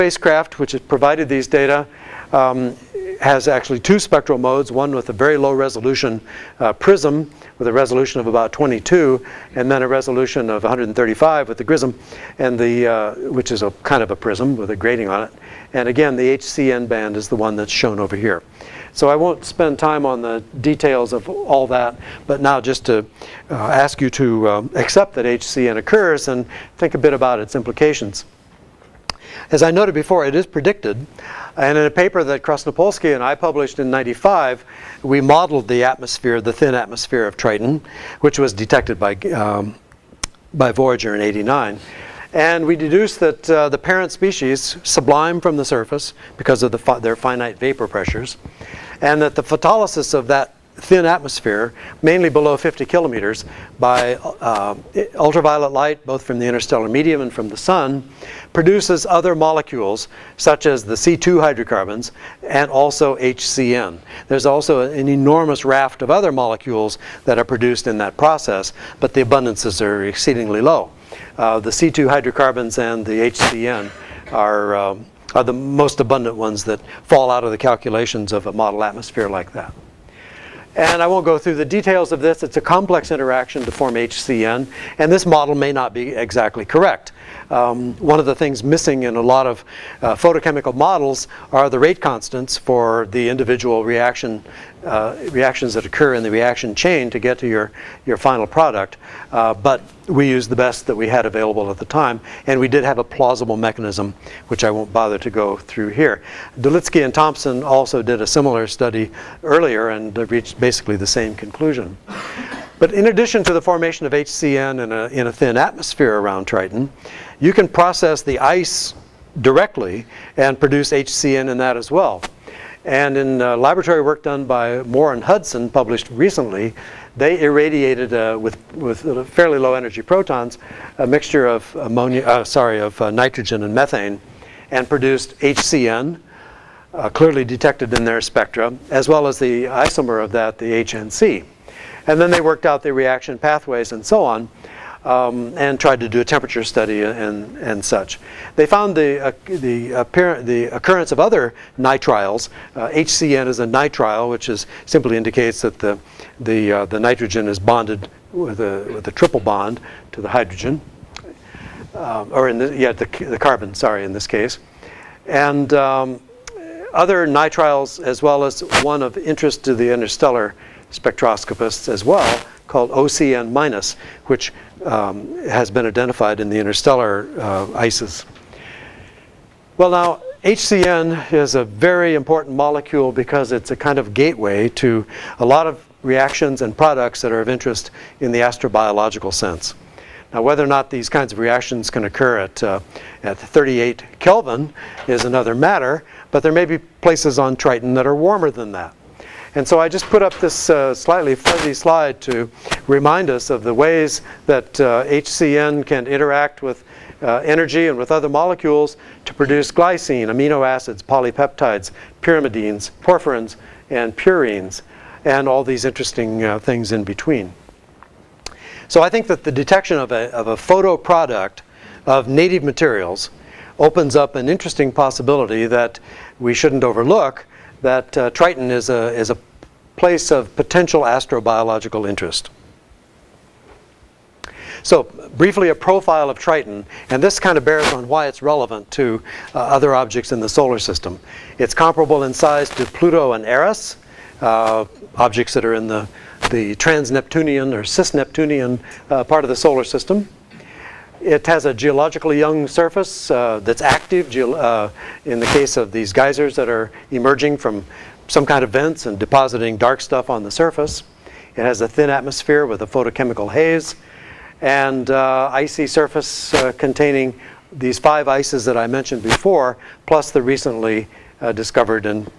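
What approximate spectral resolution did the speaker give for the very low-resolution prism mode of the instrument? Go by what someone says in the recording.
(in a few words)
22.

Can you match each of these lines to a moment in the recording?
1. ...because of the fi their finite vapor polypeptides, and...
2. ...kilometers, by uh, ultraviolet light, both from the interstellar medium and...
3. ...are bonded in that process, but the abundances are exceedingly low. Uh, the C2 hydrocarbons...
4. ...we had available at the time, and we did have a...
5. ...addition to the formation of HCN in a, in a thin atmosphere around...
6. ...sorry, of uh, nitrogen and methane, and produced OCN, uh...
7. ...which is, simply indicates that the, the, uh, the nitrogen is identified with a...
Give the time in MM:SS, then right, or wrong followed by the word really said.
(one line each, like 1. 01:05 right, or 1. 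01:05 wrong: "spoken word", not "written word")
1. 00:46 wrong: "pressures", not "polypeptides"
2. 00:52 right
3. 01:07 wrong: "produced", not "bonded"
4. 01:40 right
5. 01:53 right
6. 02:12 wrong: "HCN", not "OCN"
7. 02:34 wrong: "bonded", not "identified".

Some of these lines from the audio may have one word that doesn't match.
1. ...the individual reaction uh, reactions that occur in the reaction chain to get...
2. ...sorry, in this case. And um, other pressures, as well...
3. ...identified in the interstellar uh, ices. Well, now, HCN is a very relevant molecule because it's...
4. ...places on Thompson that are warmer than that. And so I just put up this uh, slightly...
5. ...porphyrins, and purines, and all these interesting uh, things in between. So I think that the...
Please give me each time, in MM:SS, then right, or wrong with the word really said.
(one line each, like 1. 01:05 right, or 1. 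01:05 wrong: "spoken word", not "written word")
1. 01:33 right
2. 02:43 wrong: "nitriles", not "pressures"
3. 02:55 wrong: "important", not "relevant"
4. 03:16 wrong: "Triton", not "Thompson"
5. 03:32 right.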